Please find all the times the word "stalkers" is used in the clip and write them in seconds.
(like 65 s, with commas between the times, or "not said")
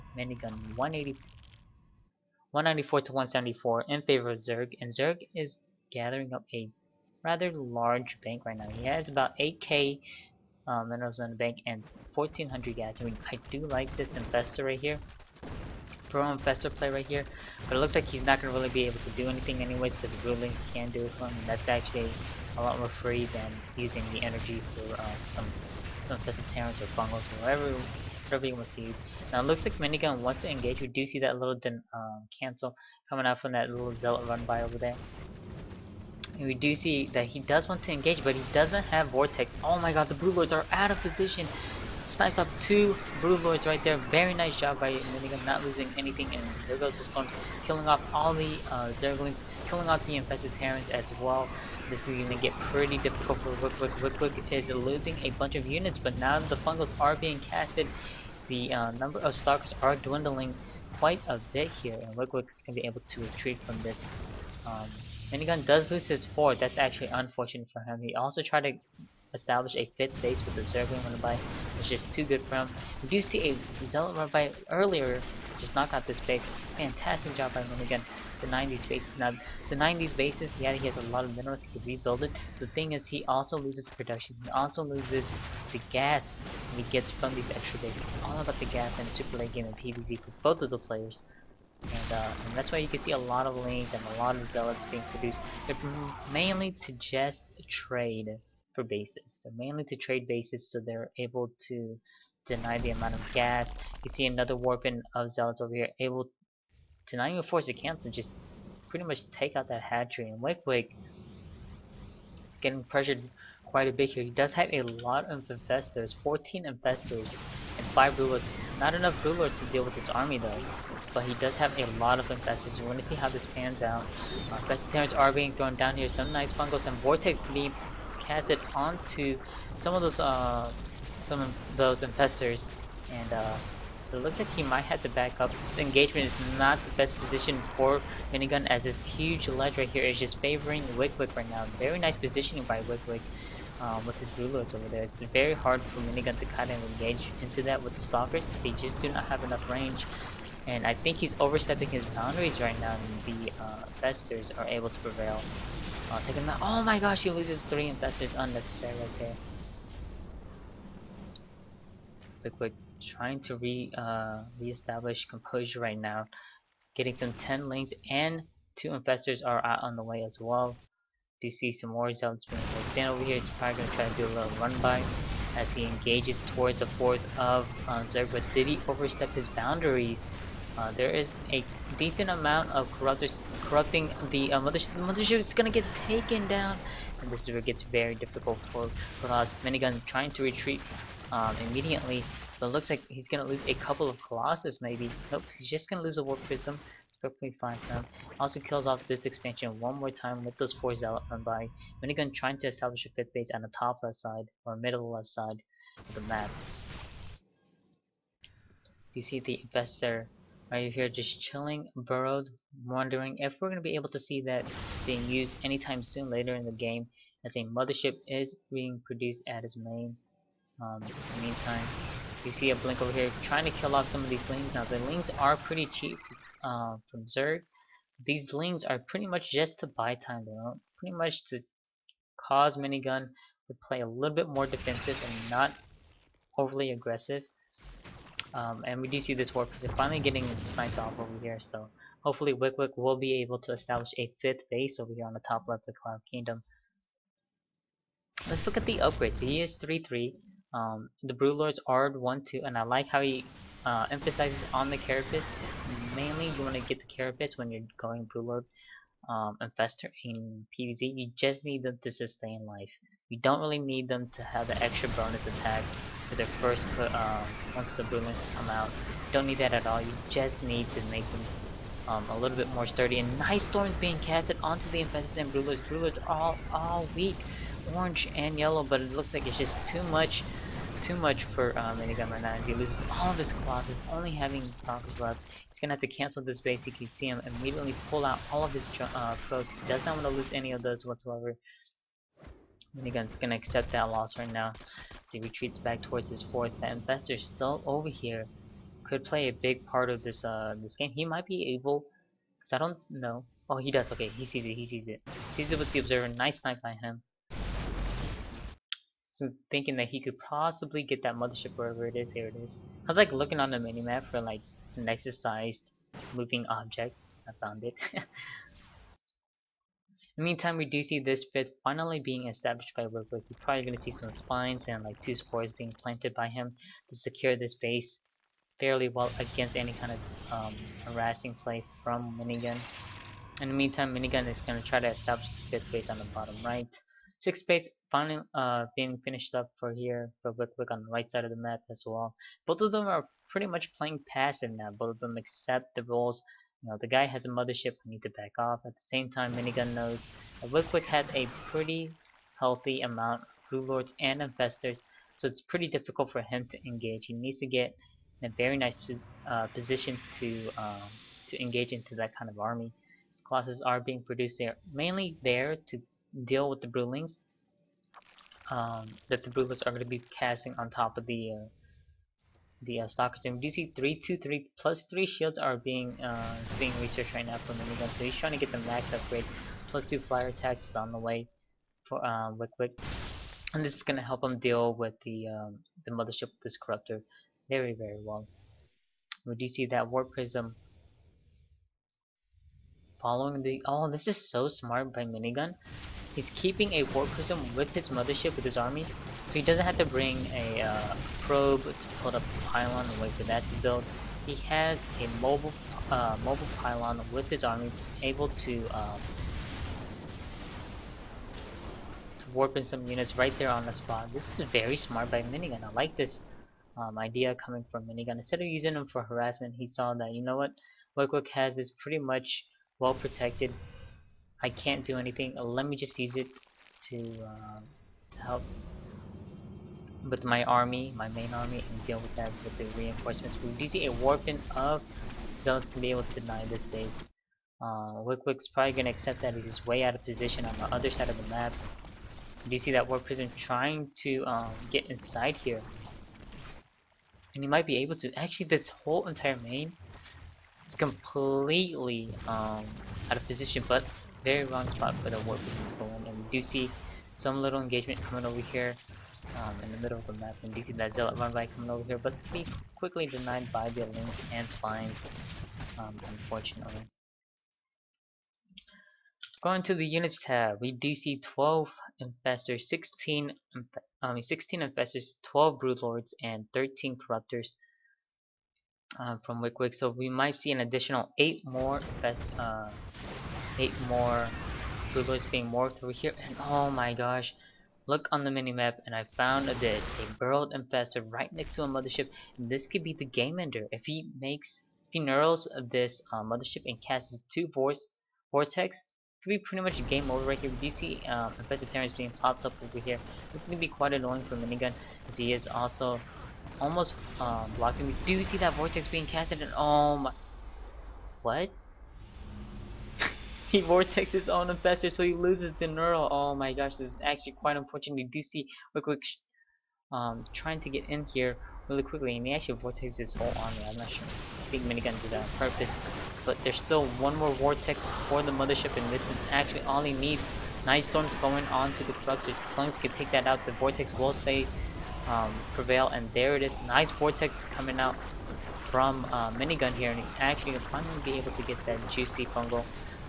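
59 s, 148 s, 284 s.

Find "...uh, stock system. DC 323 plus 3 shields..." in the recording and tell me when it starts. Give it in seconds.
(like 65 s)
373 s.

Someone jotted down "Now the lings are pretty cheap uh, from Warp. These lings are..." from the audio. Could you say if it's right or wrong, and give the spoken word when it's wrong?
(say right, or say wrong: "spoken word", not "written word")
wrong: "Zerg", not "Warp".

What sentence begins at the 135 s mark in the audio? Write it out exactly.
This engagement is not the best position for Minigun as this huge ledge right here is just favoring wickwick right now.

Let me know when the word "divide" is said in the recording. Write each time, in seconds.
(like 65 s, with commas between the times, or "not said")
not said.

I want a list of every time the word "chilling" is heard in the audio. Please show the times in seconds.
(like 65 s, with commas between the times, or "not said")
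211 s.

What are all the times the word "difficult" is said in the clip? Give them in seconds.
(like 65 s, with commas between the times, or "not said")
52 s, 188 s, 355 s.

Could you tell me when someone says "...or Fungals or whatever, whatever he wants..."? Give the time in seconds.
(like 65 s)
26 s.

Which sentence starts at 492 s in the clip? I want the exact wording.
This could be the game ender.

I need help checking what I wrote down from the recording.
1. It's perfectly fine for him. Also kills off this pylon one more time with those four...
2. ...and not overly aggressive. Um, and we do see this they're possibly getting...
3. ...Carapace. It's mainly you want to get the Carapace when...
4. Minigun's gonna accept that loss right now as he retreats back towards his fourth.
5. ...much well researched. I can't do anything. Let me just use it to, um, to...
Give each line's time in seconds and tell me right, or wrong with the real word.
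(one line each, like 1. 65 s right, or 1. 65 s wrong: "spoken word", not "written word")
1. 197 s wrong: "expansion", not "pylon"
2. 235 s wrong: "finally", not "possibly"
3. 254 s right
4. 292 s right
5. 422 s wrong: "protected", not "researched".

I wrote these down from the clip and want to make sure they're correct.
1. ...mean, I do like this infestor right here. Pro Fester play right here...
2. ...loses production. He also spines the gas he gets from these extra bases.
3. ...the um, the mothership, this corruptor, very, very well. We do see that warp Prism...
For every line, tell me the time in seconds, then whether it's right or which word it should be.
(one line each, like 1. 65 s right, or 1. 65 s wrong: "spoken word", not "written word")
1. 13 s right
2. 83 s wrong: "loses", not "spines"
3. 385 s right.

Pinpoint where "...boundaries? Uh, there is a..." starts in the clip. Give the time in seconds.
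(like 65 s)
179 s.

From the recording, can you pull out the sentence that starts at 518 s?
You do see real quick, um, trying to get in here really quickly, and he actually vortexes his whole army.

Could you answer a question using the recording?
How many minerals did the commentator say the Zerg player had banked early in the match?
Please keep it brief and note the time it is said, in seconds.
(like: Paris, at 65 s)
8k, at 9 s.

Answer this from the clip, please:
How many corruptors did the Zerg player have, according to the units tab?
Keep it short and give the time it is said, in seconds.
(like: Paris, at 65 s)
13, at 476 s.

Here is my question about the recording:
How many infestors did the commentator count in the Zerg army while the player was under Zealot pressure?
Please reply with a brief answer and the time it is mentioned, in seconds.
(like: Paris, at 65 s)
14, at 116 s.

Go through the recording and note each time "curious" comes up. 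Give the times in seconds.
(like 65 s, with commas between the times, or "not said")
not said.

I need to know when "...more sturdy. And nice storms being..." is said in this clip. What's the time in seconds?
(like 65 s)
272 s.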